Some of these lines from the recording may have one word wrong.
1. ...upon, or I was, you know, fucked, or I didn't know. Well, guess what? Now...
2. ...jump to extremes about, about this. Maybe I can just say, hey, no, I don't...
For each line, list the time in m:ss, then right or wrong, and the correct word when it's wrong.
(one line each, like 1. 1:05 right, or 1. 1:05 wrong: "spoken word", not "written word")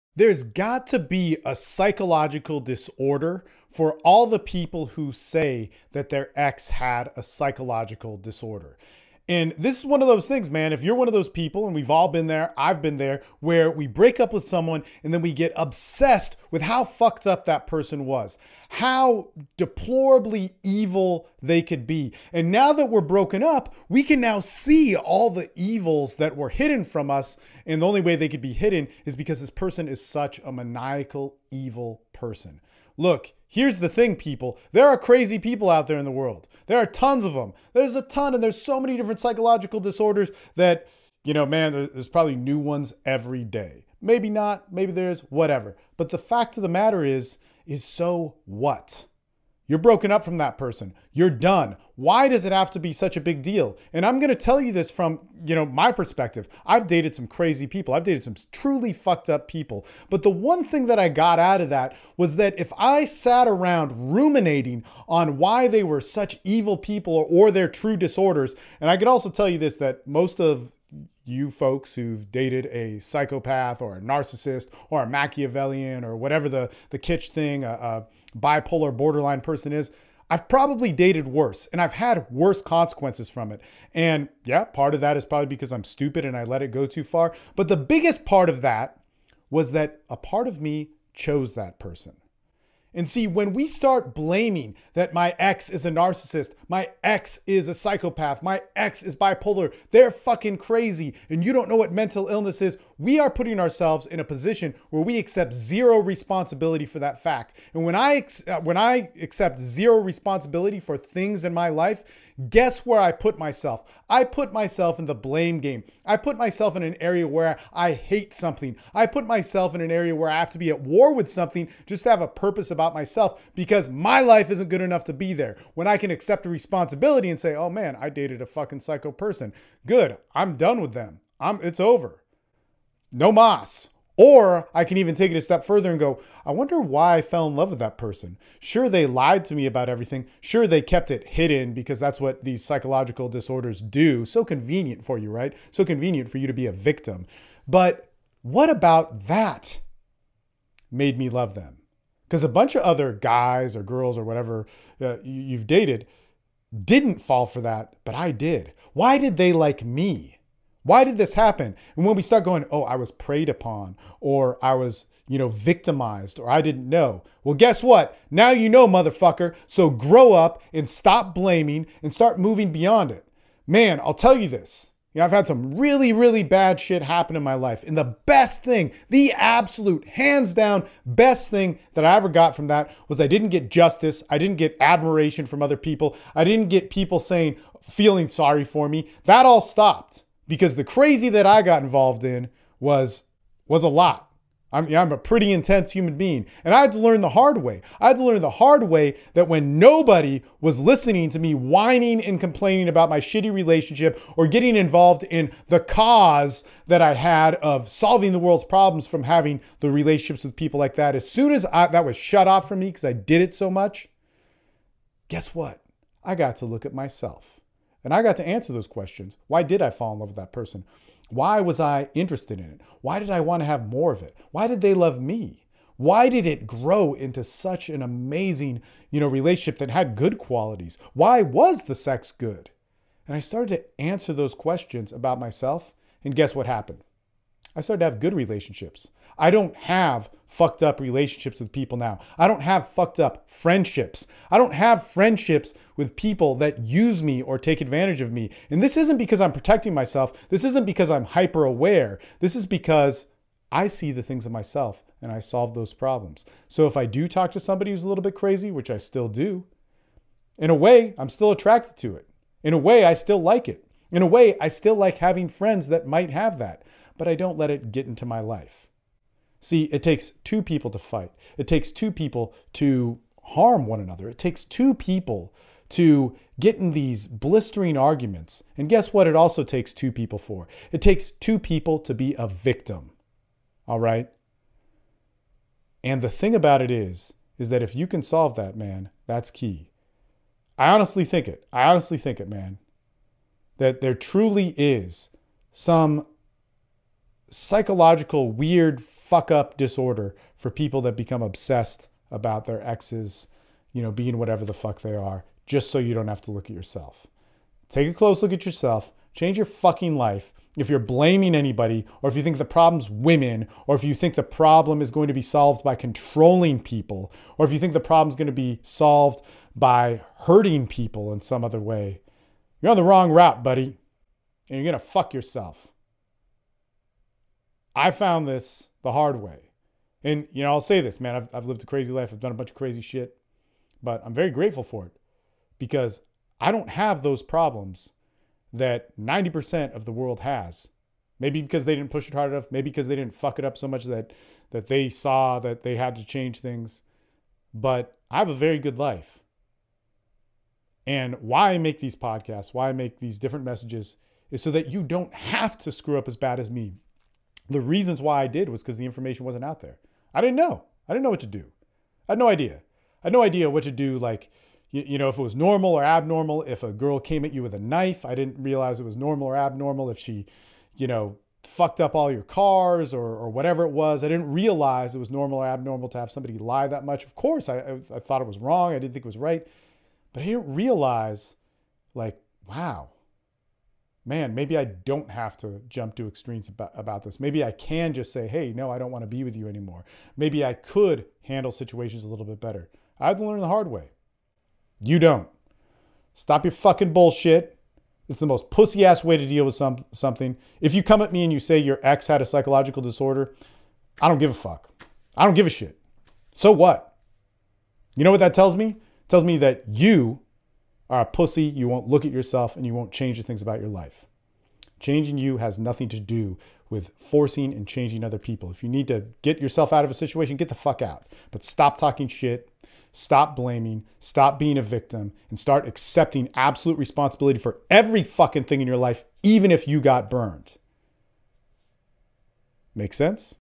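1. 2:43 wrong: "victimized", not "fucked"
2. 6:25 right.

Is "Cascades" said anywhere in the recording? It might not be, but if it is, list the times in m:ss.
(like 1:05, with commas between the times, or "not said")
not said.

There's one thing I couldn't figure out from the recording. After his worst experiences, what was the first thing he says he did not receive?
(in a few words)
justice.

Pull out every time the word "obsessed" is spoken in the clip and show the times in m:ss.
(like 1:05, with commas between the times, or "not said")
0:15, 5:01.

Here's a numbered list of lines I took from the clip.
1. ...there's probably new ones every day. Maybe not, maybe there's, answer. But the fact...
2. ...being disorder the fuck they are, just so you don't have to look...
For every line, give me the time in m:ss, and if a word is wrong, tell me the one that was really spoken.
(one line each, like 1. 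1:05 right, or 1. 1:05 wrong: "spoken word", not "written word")
1. 0:41 wrong: "whatever", not "answer"
2. 5:04 wrong: "whatever", not "disorder".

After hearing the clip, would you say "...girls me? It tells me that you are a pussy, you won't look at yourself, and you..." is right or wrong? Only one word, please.
wrong.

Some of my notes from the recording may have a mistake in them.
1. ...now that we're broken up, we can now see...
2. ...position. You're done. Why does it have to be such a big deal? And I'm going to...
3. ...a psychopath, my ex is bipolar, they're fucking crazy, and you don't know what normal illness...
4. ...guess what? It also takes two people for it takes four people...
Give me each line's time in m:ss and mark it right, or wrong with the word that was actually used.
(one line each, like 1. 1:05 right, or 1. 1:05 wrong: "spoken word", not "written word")
1. 0:22 right
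2. 0:50 wrong: "person", not "position"
3. 1:37 wrong: "mental", not "normal"
4. 4:38 wrong: "two", not "four".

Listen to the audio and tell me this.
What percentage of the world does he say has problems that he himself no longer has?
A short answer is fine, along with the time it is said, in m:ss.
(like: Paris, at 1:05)
90%, at 5:39.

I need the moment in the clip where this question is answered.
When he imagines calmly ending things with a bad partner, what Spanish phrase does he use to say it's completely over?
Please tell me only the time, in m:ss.
2:13.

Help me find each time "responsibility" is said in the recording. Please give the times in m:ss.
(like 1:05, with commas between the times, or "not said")
1:45, 1:49, 2:06, 7:06.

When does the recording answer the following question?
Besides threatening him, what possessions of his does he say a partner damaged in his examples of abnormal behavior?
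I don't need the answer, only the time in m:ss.
6:12.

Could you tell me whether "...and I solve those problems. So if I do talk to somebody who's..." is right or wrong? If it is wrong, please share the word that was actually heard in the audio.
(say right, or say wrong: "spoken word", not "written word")
right.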